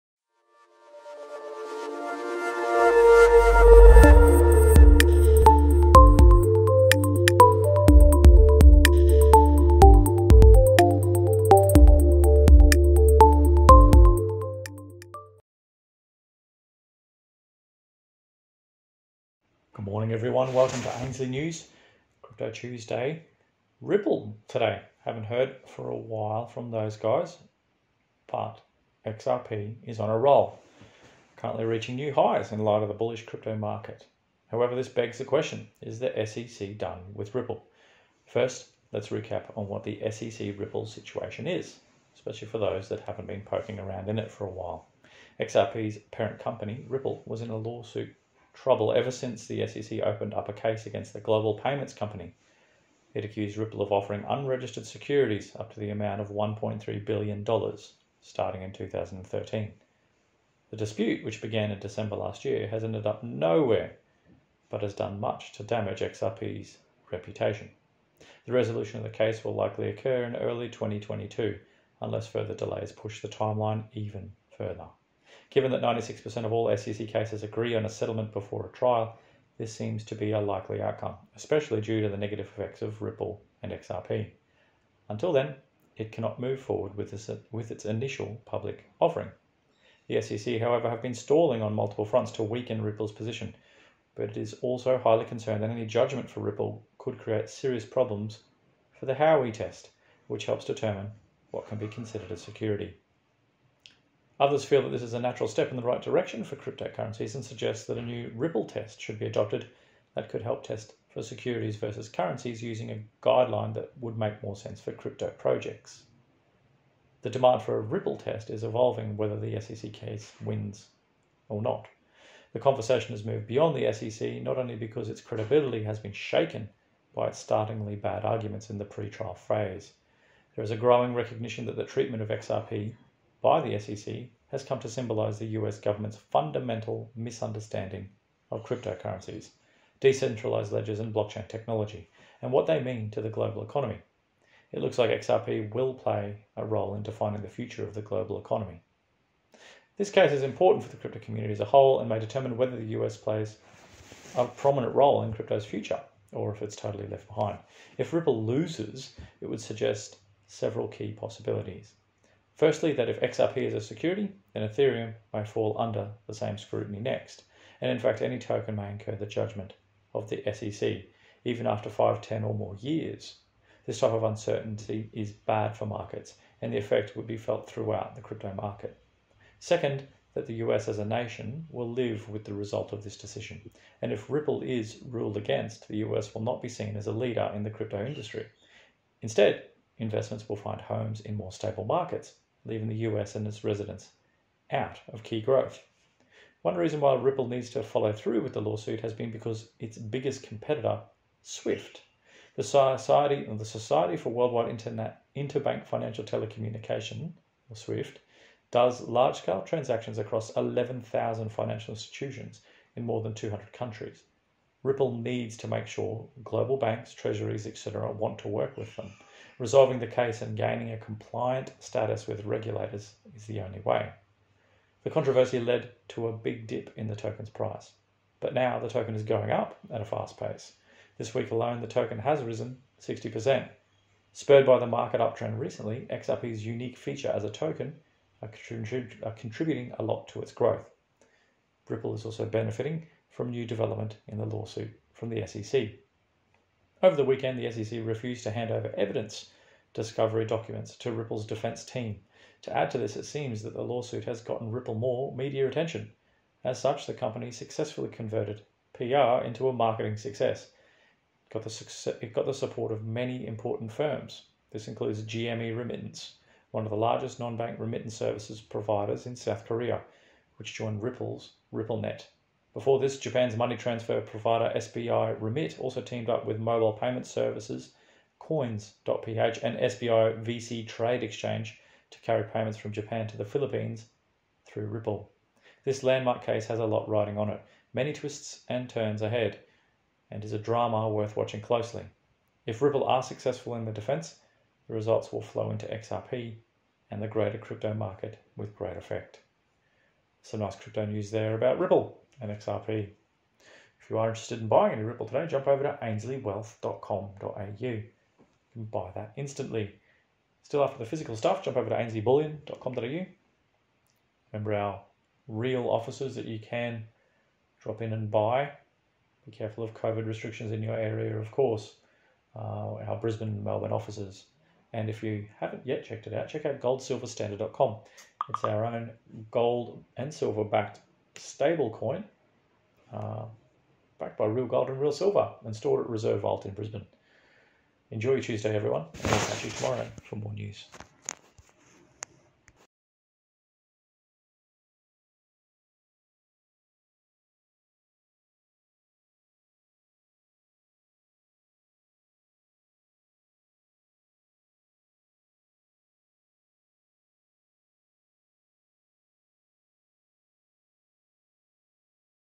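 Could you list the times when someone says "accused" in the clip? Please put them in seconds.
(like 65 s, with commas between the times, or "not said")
53 s.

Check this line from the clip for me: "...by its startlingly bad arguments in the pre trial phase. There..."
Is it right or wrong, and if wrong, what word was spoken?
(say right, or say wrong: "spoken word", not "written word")
right.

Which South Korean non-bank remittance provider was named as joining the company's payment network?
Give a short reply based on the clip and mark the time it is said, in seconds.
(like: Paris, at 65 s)
GME Remittance, at 265 s.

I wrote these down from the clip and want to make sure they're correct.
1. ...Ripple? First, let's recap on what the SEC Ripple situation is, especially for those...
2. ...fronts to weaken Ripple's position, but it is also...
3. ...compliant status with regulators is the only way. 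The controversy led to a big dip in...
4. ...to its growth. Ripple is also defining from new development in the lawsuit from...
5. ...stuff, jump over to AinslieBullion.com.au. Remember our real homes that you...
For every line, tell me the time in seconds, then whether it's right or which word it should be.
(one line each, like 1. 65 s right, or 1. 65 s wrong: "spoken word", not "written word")
1. 37 s right
2. 92 s right
3. 220 s right
4. 240 s wrong: "benefiting", not "defining"
5. 311 s wrong: "offices", not "homes".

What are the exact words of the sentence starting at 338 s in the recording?
Enjoy your Tuesday, everyone, and I'll catch you tomorrow for more news.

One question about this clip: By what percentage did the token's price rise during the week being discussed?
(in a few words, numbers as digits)
60%.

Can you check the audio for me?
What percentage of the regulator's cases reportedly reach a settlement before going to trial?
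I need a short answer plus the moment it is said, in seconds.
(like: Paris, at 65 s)
96%, at 75 s.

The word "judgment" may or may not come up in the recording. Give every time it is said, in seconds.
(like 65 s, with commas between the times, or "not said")
95 s, 169 s.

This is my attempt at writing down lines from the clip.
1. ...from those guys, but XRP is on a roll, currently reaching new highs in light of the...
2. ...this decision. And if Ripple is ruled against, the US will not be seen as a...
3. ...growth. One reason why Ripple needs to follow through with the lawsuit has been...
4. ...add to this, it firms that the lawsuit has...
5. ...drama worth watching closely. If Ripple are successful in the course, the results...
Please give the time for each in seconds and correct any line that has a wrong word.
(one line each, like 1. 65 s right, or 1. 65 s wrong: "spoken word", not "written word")
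1. 26 s right
2. 183 s right
3. 195 s right
4. 252 s wrong: "seems", not "firms"
5. 290 s wrong: "defense", not "course".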